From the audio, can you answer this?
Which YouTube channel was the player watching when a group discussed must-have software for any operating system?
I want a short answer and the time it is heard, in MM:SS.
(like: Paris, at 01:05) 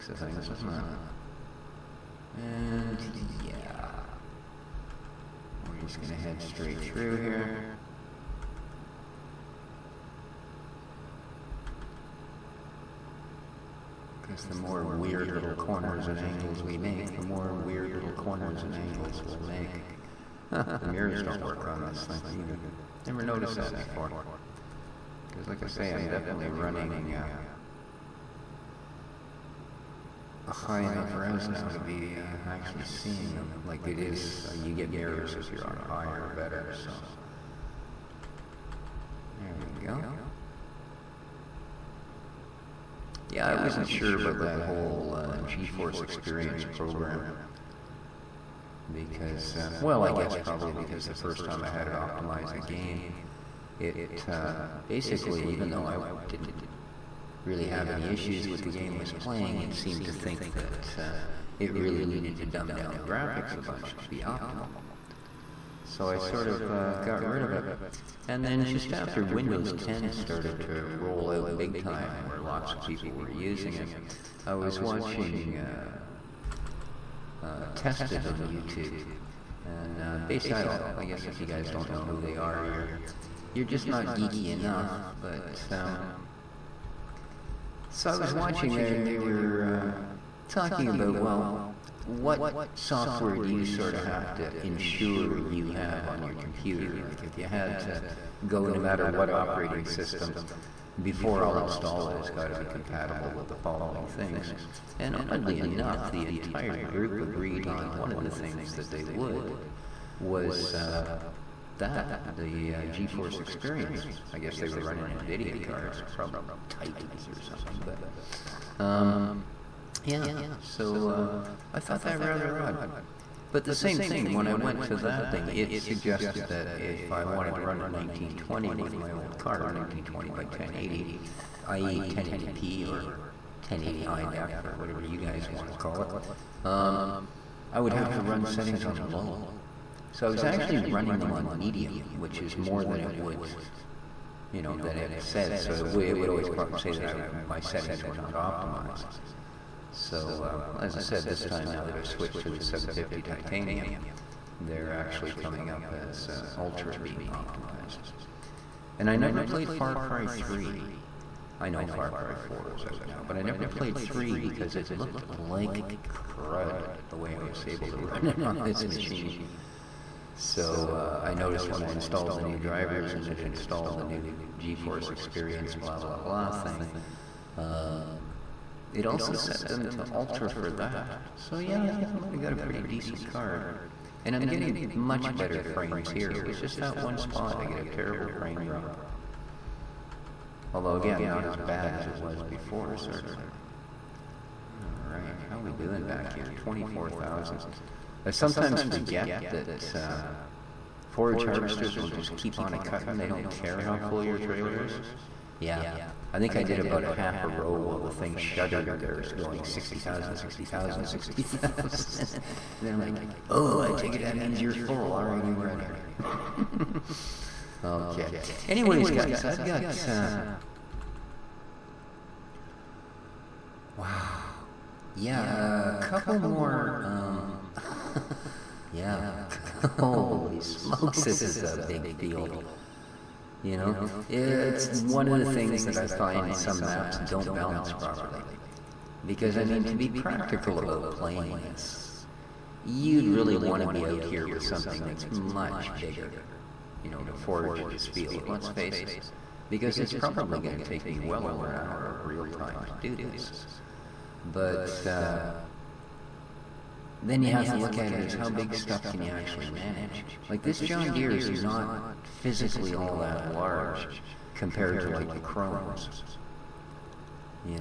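Tested, at 01:17.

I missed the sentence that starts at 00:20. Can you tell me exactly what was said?
Huh, the mirrors don't work on this thing either.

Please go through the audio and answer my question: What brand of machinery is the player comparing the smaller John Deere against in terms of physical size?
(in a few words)
Krones.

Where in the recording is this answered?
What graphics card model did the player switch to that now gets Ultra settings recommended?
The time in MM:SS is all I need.
02:32.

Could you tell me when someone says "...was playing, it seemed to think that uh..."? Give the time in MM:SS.
00:58.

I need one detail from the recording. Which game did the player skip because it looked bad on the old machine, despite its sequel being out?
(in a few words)
Far Cry 3.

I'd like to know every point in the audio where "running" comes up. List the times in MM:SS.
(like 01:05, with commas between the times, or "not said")
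00:26, 01:54, 02:20.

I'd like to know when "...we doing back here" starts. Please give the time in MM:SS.
03:15.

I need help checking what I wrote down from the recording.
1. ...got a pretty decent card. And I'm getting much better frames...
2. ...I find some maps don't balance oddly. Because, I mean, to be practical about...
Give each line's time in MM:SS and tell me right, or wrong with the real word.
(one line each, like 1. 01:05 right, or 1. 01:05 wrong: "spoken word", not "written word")
1. 03:02 right
2. 03:55 wrong: "properly", not "oddly".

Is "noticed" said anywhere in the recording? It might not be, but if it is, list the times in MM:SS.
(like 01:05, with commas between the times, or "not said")
00:23, 02:51.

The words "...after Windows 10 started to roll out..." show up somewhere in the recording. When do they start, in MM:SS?
01:08.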